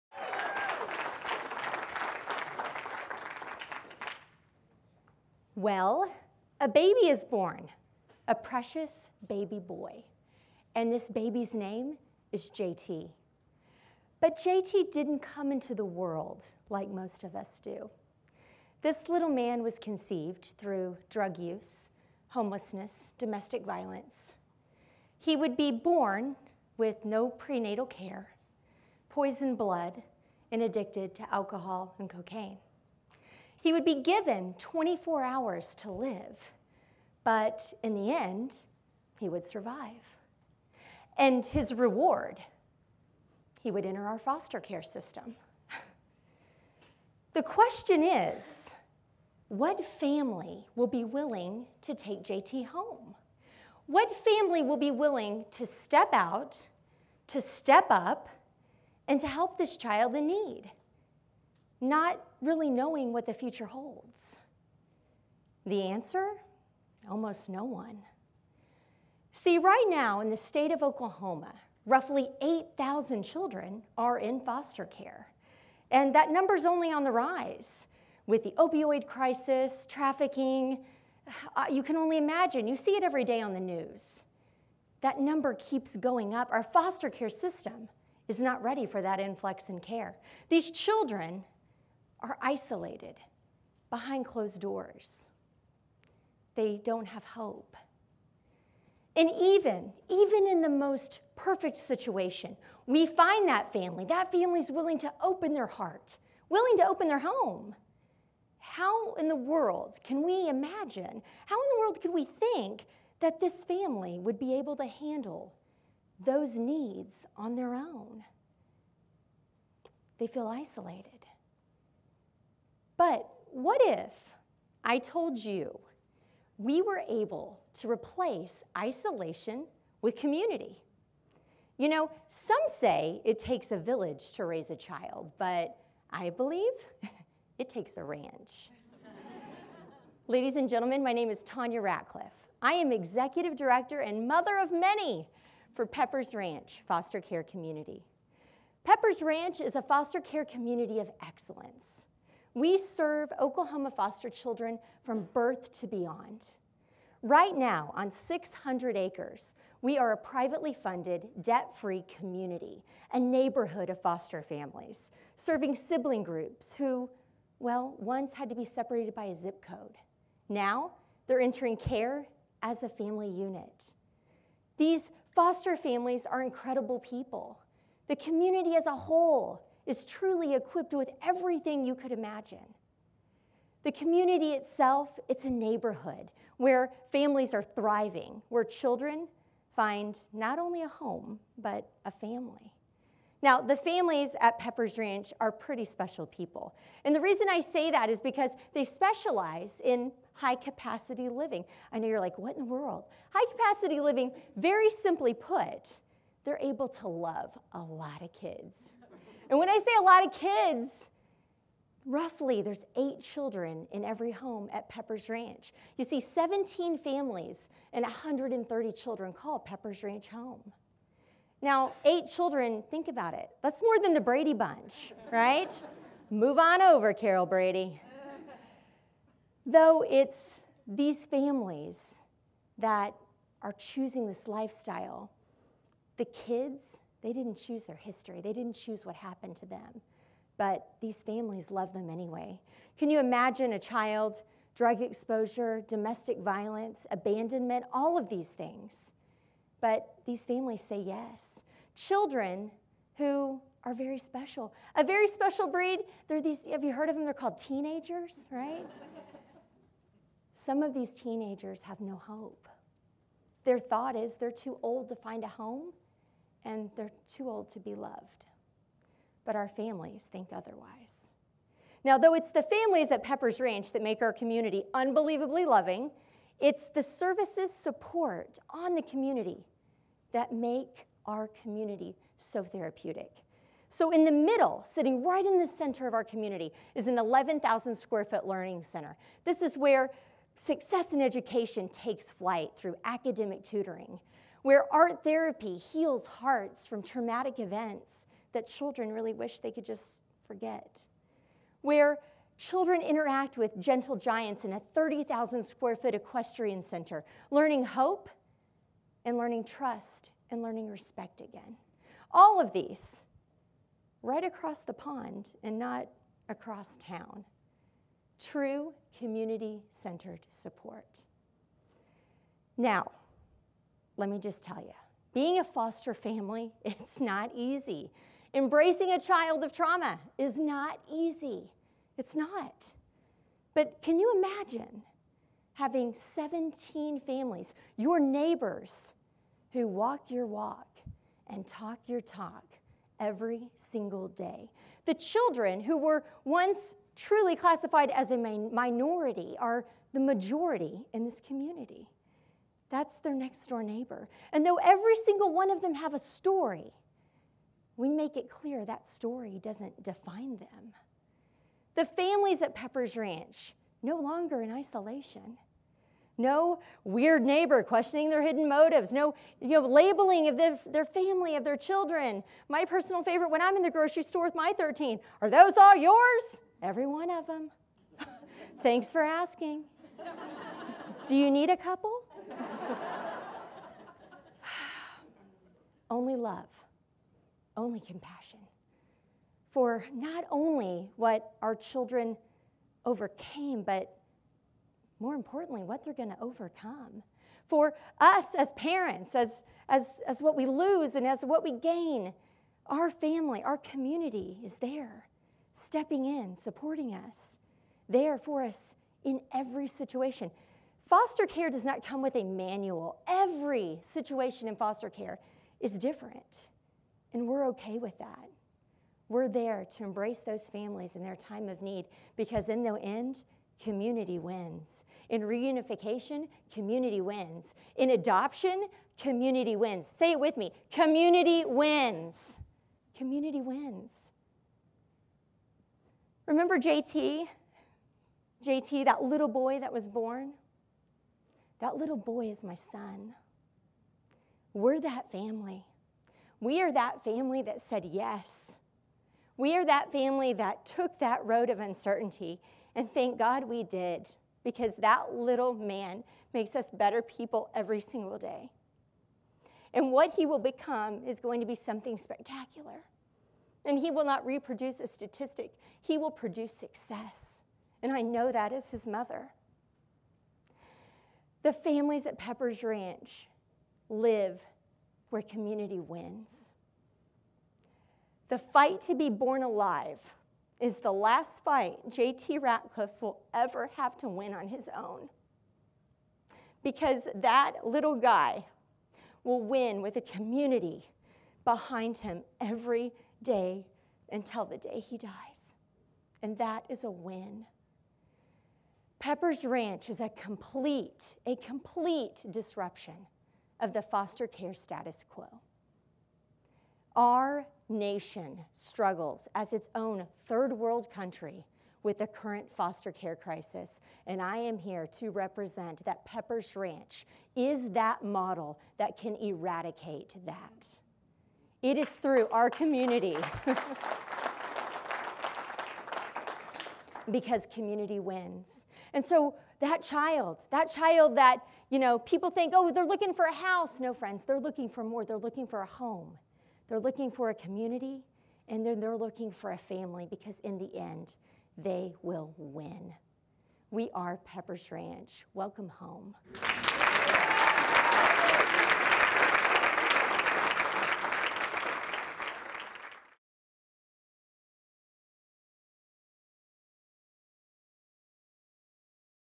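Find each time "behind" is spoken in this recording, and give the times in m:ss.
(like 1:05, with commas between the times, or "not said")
1:33, 8:11.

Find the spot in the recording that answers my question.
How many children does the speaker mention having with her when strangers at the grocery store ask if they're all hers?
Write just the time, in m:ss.
6:14.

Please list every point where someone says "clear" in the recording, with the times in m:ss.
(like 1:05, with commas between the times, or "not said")
5:58.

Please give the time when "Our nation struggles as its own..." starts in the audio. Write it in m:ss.
8:27.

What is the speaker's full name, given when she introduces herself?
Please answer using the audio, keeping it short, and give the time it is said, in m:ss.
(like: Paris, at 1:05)
Tanya Ratcliffe, at 2:21.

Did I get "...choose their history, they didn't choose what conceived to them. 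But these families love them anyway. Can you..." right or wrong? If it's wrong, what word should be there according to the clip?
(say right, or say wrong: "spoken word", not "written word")
wrong: "happened", not "conceived".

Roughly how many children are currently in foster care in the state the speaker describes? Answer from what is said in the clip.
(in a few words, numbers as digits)
8,000.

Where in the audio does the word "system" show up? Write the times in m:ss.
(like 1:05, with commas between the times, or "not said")
0:44, 1:27.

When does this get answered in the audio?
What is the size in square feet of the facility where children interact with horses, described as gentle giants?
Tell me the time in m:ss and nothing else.
5:04.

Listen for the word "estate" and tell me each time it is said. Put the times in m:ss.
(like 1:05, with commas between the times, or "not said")
not said.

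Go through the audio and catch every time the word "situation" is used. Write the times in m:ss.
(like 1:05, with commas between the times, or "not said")
1:41, 6:49, 6:54.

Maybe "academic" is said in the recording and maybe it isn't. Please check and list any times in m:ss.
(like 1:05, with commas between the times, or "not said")
4:53.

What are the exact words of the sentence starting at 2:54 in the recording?
These foster families are incredible people.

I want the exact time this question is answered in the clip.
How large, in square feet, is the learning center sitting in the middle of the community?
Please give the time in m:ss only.
4:47.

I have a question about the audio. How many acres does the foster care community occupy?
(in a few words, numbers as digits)
600.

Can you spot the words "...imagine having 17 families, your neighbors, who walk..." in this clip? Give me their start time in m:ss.
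5:34.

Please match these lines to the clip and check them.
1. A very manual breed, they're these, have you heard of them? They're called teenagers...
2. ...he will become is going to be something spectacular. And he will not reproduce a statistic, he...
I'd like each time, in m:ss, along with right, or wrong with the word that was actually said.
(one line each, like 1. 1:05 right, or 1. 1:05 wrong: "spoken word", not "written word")
1. 4:14 wrong: "special", not "manual"
2. 7:40 right.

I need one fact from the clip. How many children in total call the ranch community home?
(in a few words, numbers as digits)
130.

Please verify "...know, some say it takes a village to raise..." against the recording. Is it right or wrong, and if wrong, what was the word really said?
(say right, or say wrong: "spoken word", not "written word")
right.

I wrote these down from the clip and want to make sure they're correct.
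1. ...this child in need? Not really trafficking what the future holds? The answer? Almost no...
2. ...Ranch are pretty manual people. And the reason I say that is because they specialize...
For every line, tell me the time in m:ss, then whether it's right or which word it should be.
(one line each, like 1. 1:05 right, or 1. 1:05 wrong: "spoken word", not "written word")
1. 0:59 wrong: "knowing", not "trafficking"
2. 3:14 wrong: "special", not "manual".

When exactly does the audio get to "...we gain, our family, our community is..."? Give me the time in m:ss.
6:41.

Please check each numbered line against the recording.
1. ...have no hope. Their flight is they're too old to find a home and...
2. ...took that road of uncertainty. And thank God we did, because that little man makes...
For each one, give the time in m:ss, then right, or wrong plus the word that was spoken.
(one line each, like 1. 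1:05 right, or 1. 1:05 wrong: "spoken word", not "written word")
1. 4:21 wrong: "thought", not "flight"
2. 7:30 right.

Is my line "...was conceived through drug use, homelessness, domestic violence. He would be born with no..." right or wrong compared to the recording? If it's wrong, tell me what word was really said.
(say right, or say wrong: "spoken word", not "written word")
right.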